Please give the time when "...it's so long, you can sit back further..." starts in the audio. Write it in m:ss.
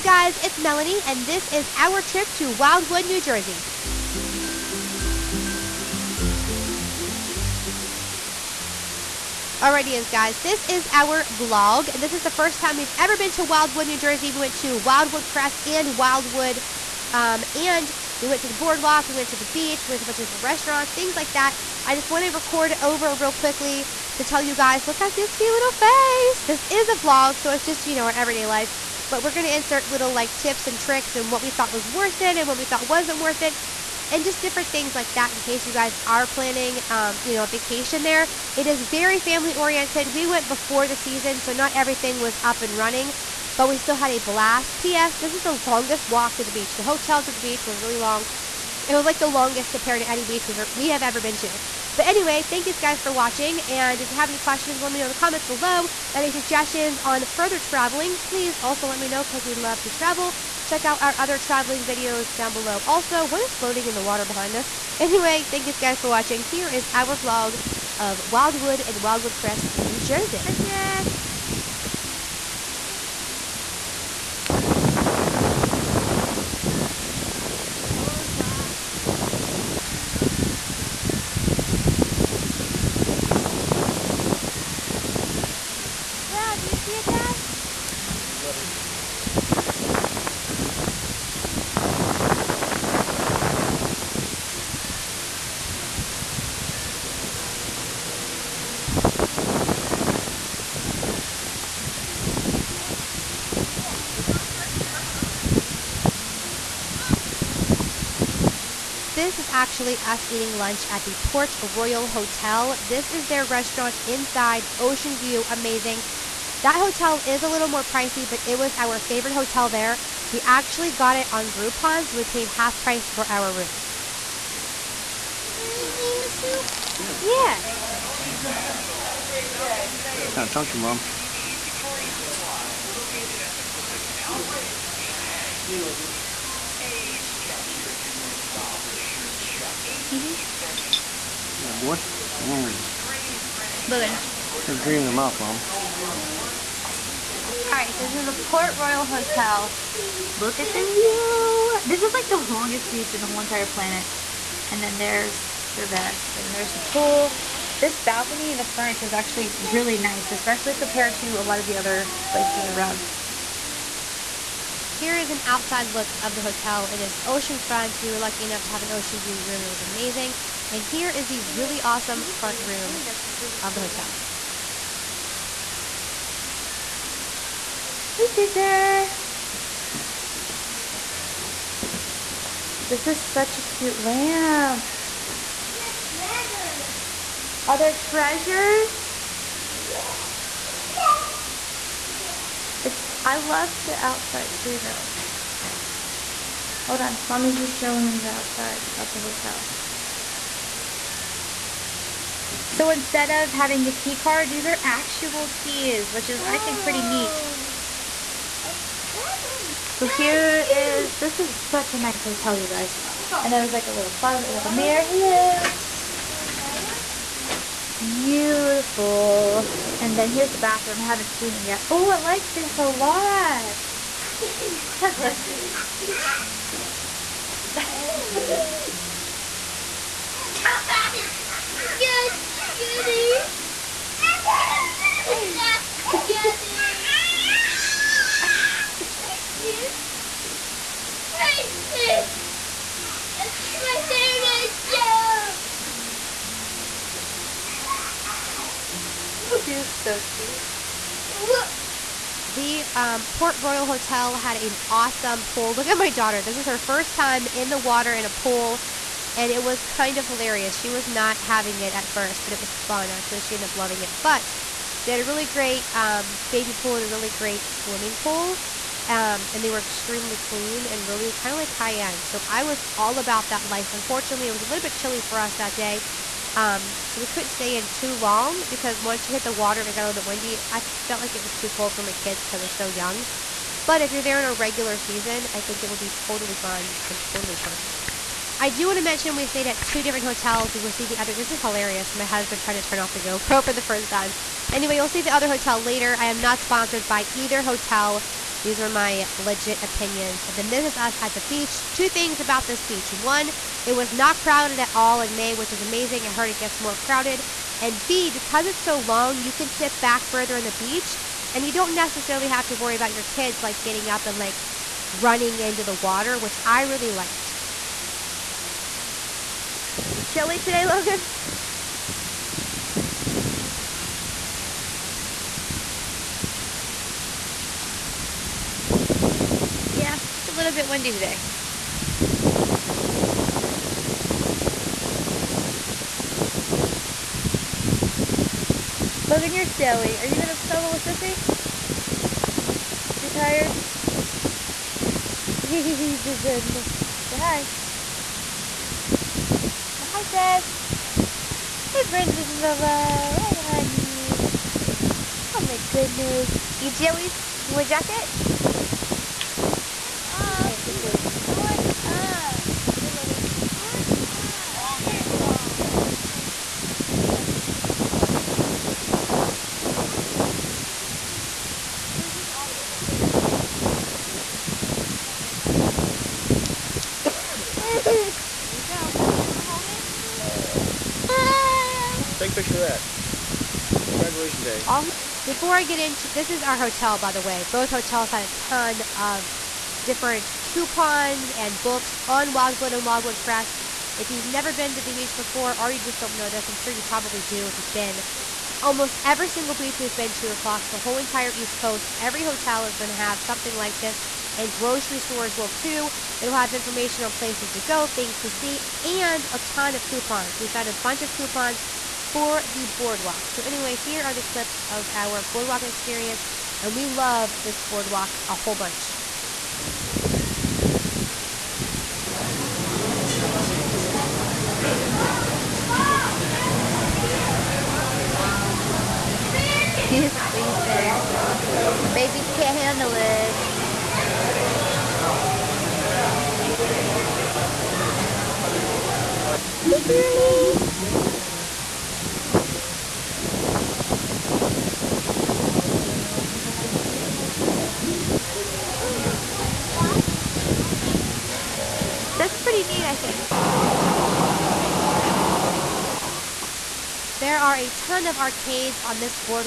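5:08.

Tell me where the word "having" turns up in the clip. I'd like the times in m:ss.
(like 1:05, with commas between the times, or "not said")
3:23, 4:21.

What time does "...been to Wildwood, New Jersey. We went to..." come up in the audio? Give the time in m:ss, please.
0:13.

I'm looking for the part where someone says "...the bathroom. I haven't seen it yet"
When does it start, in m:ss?
3:40.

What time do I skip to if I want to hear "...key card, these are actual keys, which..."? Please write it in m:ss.
3:23.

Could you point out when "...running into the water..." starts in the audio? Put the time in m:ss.
5:15.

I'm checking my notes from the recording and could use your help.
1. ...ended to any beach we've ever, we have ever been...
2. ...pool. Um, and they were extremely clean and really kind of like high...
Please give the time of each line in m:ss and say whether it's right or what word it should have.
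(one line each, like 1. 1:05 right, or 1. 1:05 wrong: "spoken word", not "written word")
1. 0:49 wrong: "compared", not "ended"
2. 4:28 right.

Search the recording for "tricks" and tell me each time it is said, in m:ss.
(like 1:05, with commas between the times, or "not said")
0:30.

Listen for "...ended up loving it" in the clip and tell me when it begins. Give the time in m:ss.
4:23.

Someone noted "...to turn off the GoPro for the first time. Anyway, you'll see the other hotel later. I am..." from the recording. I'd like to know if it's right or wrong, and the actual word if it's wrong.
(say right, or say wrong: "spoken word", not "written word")
right.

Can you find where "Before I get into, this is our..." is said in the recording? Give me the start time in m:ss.
6:25.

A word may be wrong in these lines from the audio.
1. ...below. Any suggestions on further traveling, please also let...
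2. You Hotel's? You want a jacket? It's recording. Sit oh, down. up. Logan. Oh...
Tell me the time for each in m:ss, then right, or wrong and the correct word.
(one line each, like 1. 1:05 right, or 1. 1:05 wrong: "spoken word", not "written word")
1. 0:55 right
2. 5:56 wrong: "Joey", not "Hotel".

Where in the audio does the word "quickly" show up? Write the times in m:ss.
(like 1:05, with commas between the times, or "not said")
0:23.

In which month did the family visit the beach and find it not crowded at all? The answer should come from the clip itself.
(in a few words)
May.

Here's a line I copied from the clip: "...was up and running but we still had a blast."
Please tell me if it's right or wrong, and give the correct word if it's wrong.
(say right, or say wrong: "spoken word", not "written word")
right.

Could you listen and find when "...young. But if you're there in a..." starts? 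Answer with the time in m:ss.
4:42.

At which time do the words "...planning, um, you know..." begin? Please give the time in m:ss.
0:36.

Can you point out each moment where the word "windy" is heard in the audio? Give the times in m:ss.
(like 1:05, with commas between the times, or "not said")
4:40, 5:30.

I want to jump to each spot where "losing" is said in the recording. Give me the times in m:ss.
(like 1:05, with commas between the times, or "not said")
not said.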